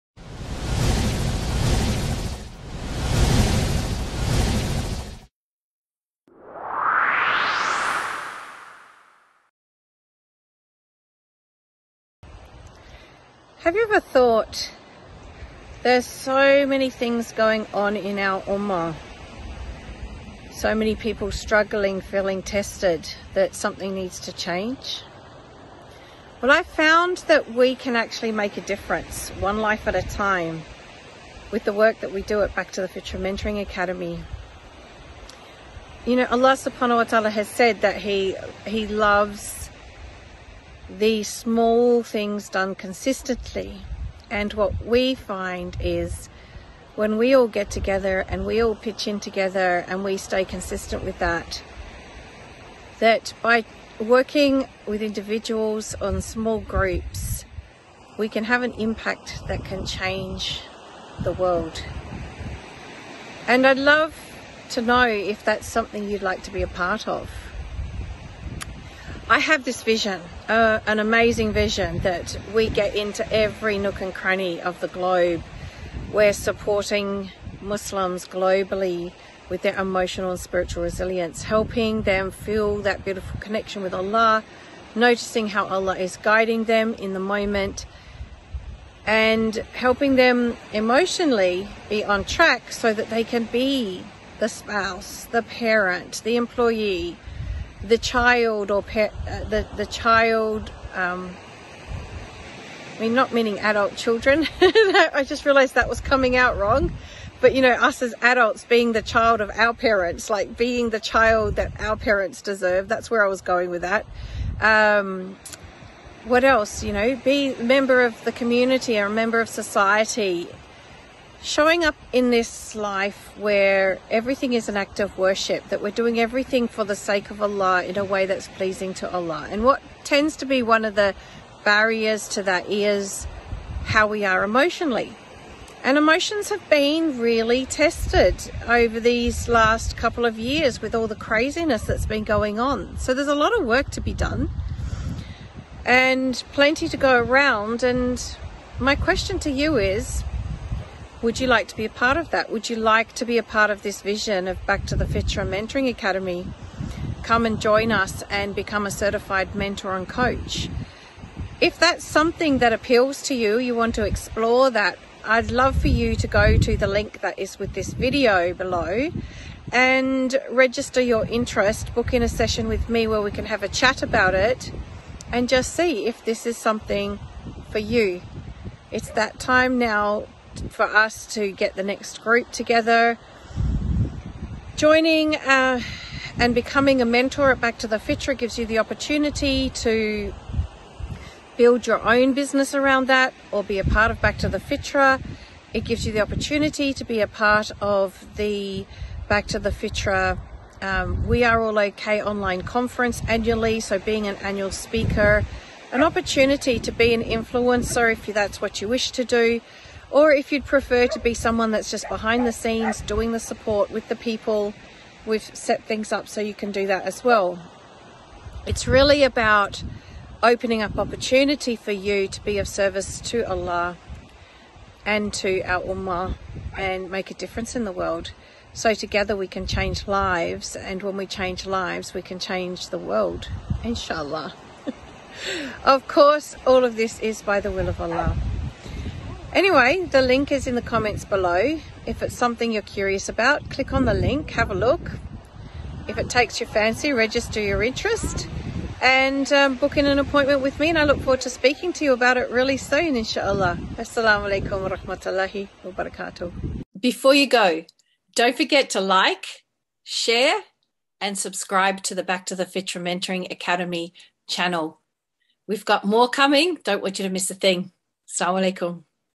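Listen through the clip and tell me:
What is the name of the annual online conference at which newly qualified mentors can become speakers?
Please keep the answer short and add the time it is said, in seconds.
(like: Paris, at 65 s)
We Are All Okay, at 201 s.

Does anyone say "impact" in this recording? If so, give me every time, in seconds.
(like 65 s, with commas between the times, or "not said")
58 s.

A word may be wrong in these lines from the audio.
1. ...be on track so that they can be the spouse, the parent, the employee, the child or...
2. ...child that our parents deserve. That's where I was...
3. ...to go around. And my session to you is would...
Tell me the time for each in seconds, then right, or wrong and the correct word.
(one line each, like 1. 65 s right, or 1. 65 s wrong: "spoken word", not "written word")
1. 91 s right
2. 110 s right
3. 146 s wrong: "question", not "session".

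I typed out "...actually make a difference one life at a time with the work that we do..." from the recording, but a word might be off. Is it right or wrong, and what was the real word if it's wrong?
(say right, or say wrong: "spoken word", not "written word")
right.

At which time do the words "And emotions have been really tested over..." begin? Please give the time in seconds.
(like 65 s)
135 s.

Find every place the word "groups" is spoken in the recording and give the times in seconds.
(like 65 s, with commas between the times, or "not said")
56 s, 182 s.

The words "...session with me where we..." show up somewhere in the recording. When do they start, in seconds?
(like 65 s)
172 s.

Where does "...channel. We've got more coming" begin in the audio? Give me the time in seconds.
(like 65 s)
264 s.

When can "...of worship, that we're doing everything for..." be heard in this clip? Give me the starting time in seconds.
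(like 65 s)
124 s.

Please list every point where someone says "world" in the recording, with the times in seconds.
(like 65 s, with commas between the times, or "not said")
61 s, 227 s, 232 s.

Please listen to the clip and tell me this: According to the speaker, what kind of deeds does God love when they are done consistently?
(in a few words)
Small things.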